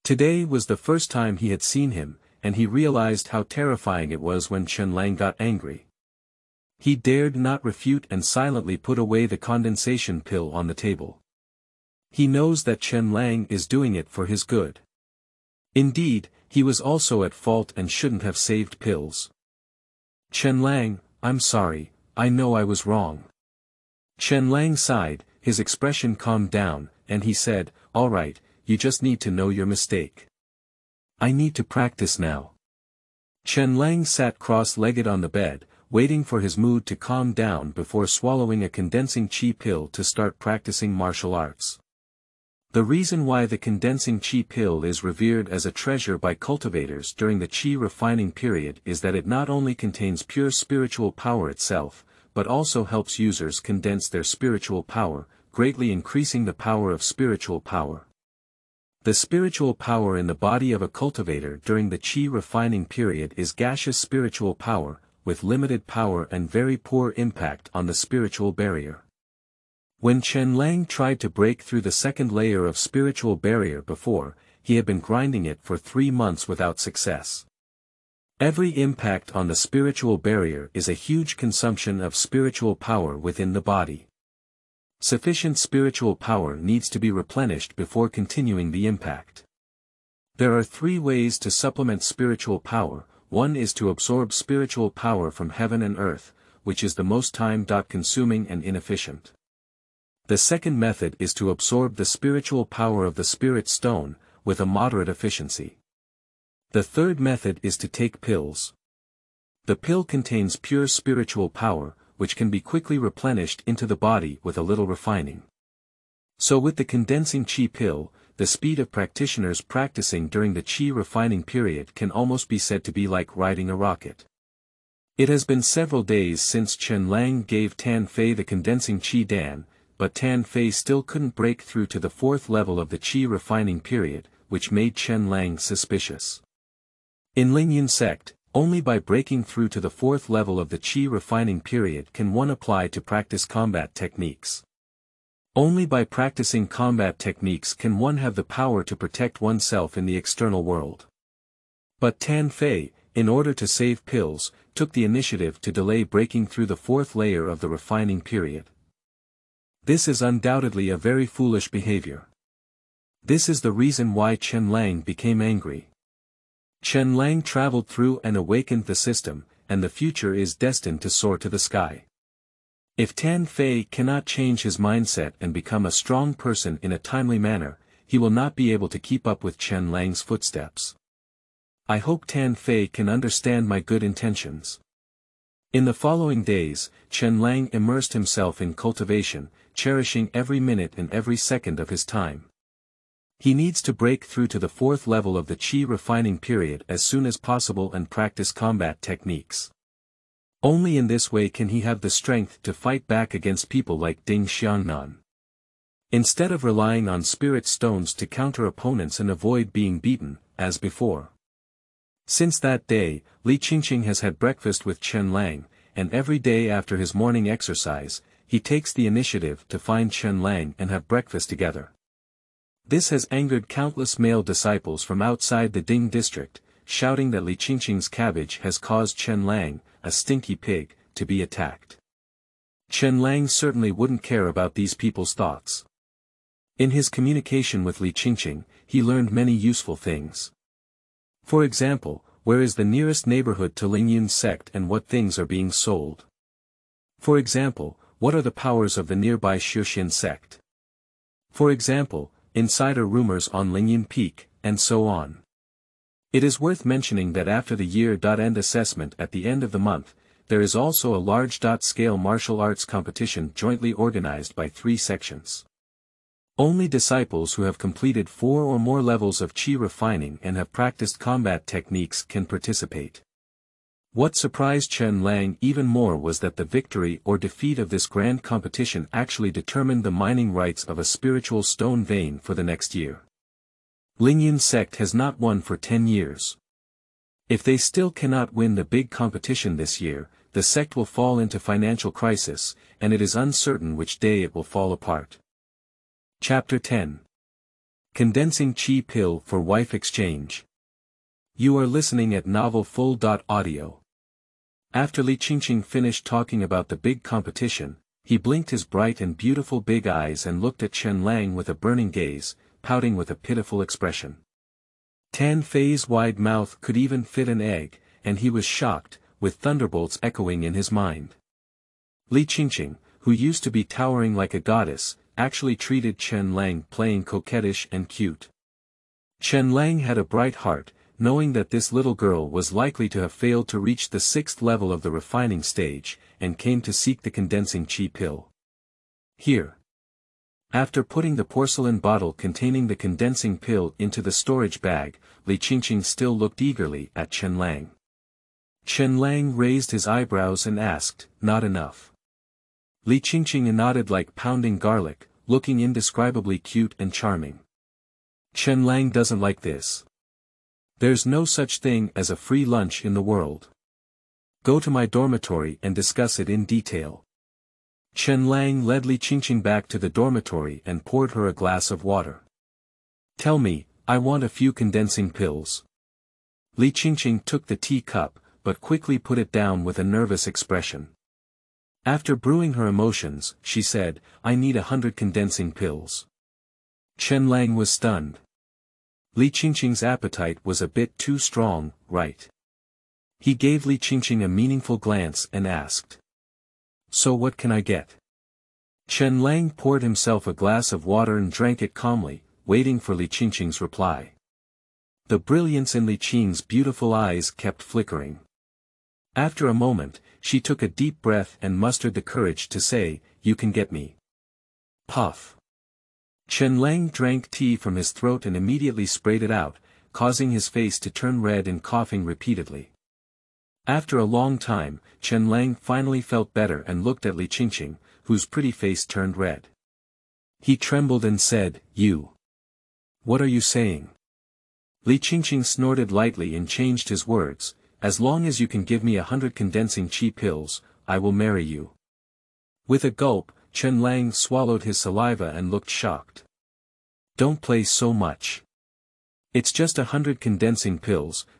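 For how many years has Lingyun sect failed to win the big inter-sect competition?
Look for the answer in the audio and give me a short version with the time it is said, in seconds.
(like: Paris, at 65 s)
10, at 285 s.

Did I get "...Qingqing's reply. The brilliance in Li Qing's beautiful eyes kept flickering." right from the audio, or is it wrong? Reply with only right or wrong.
right.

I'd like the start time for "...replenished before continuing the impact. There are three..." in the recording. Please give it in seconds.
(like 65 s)
87 s.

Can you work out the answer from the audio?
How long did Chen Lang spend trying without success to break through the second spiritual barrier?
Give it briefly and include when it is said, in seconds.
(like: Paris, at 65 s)
3 months, at 75 s.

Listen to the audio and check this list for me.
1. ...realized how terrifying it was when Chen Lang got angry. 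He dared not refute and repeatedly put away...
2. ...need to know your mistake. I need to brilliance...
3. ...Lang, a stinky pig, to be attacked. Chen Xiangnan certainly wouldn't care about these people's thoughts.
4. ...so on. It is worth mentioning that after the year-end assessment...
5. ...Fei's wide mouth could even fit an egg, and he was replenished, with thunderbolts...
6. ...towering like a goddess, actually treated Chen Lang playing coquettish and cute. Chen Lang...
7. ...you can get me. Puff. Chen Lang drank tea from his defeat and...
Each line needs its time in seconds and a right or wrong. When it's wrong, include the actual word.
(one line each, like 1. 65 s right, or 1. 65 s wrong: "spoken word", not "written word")
1. 2 s wrong: "silently", not "repeatedly"
2. 29 s wrong: "practice", not "brilliance"
3. 229 s wrong: "Lang", not "Xiangnan"
4. 254 s right
5. 315 s wrong: "shocked", not "replenished"
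6. 323 s right
7. 413 s wrong: "throat", not "defeat".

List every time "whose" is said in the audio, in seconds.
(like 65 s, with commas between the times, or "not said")
428 s.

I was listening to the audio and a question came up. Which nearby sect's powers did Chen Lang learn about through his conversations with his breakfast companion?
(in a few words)
Shushin sect.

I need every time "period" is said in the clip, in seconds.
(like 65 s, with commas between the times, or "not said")
48 s, 62 s, 121 s, 133 s, 141 s, 158 s, 196 s.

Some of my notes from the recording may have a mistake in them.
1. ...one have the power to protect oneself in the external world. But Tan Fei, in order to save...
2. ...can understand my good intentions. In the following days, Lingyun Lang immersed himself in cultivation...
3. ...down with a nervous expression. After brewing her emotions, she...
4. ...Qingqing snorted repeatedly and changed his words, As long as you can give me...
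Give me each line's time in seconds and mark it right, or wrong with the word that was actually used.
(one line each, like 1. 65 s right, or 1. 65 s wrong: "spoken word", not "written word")
1. 147 s right
2. 182 s wrong: "Chen", not "Lingyun"
3. 379 s right
4. 435 s wrong: "lightly", not "repeatedly".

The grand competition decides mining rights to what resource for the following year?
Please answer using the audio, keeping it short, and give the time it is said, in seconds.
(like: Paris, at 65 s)
spiritual stone vein, at 281 s.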